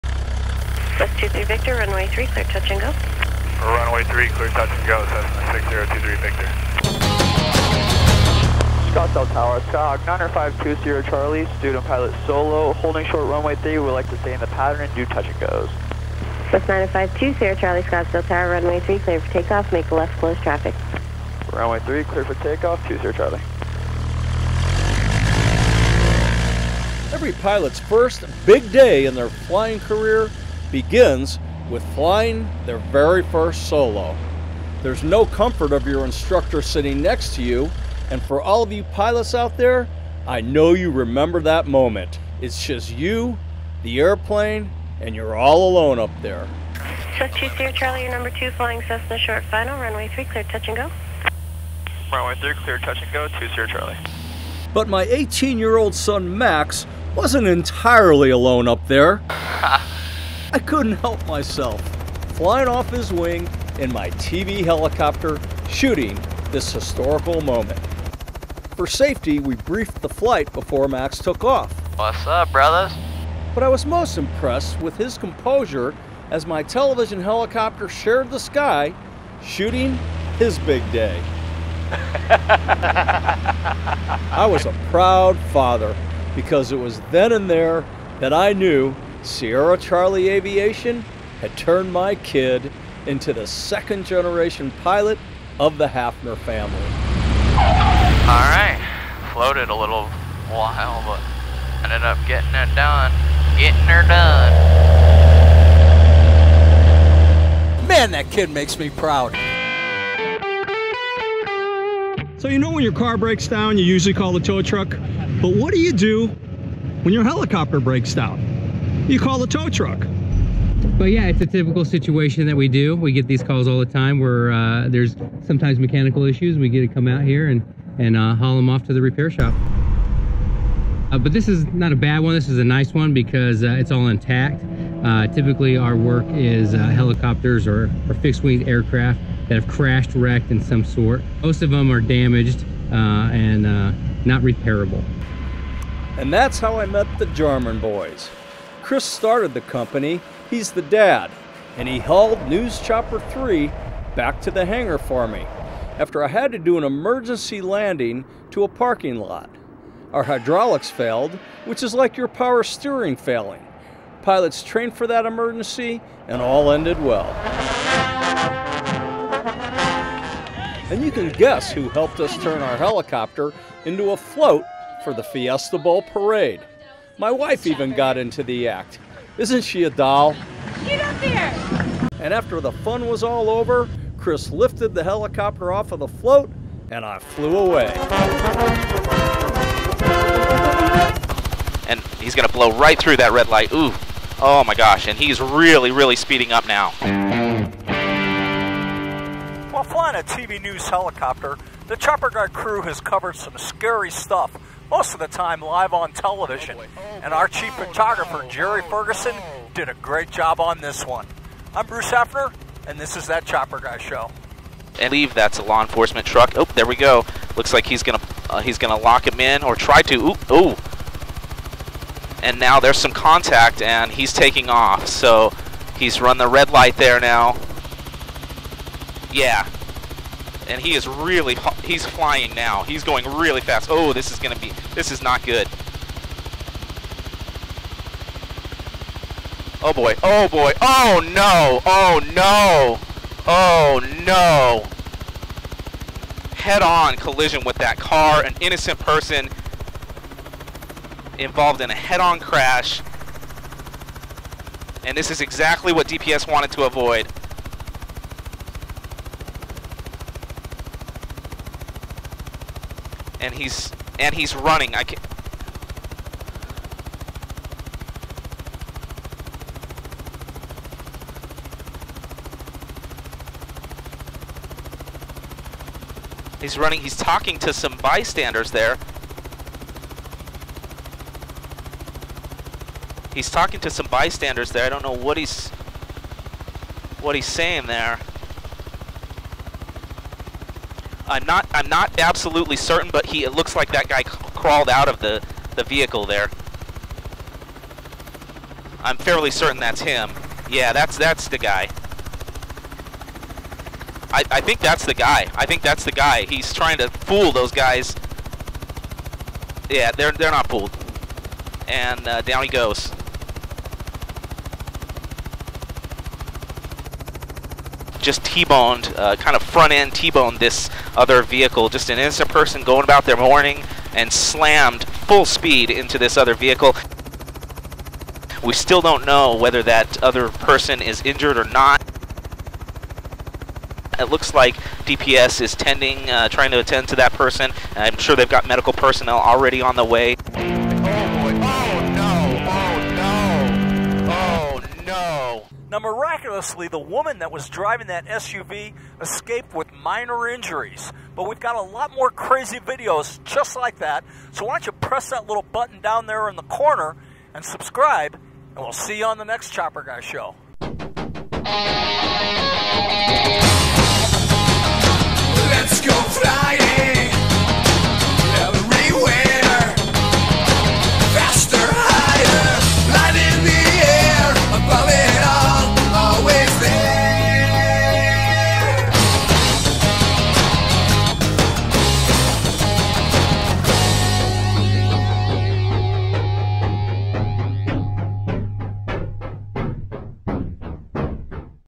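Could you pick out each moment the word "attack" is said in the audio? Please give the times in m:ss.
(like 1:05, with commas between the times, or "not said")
not said.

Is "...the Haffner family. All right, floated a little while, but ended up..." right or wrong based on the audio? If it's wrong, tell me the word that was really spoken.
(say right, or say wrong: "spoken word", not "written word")
right.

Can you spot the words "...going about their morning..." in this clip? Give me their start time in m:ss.
5:22.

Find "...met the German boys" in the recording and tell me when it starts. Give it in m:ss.
2:26.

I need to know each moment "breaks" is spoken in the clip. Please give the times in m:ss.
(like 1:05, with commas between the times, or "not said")
1:53, 1:57.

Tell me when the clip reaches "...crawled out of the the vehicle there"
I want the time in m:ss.
4:54.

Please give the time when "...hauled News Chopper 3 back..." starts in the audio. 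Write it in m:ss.
2:31.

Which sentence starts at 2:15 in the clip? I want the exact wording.
Uh, typically our work is uh, helicopters or, or fixed wing aircraft that have crashed, wrecked in some sort.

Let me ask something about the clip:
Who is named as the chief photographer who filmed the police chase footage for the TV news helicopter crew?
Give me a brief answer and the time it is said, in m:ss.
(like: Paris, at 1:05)
Jerry Ferguson, at 3:28.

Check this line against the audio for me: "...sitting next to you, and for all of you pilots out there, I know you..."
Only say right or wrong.
right.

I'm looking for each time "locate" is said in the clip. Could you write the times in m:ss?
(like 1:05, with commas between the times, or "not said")
not said.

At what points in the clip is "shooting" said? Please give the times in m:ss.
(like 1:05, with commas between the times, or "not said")
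1:05, 1:19.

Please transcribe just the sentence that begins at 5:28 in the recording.
We still don't know whether that other person is injured or not.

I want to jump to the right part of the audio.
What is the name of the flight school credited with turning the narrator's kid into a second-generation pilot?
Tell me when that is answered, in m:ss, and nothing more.
1:29.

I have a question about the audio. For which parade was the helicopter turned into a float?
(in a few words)
Fiesta Bowl parade.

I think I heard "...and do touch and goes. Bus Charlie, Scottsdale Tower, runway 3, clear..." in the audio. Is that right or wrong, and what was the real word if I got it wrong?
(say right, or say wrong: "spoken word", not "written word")
right.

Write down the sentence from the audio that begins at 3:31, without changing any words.
I'm Bruce Haffner, and this is That Chopper Guy Show.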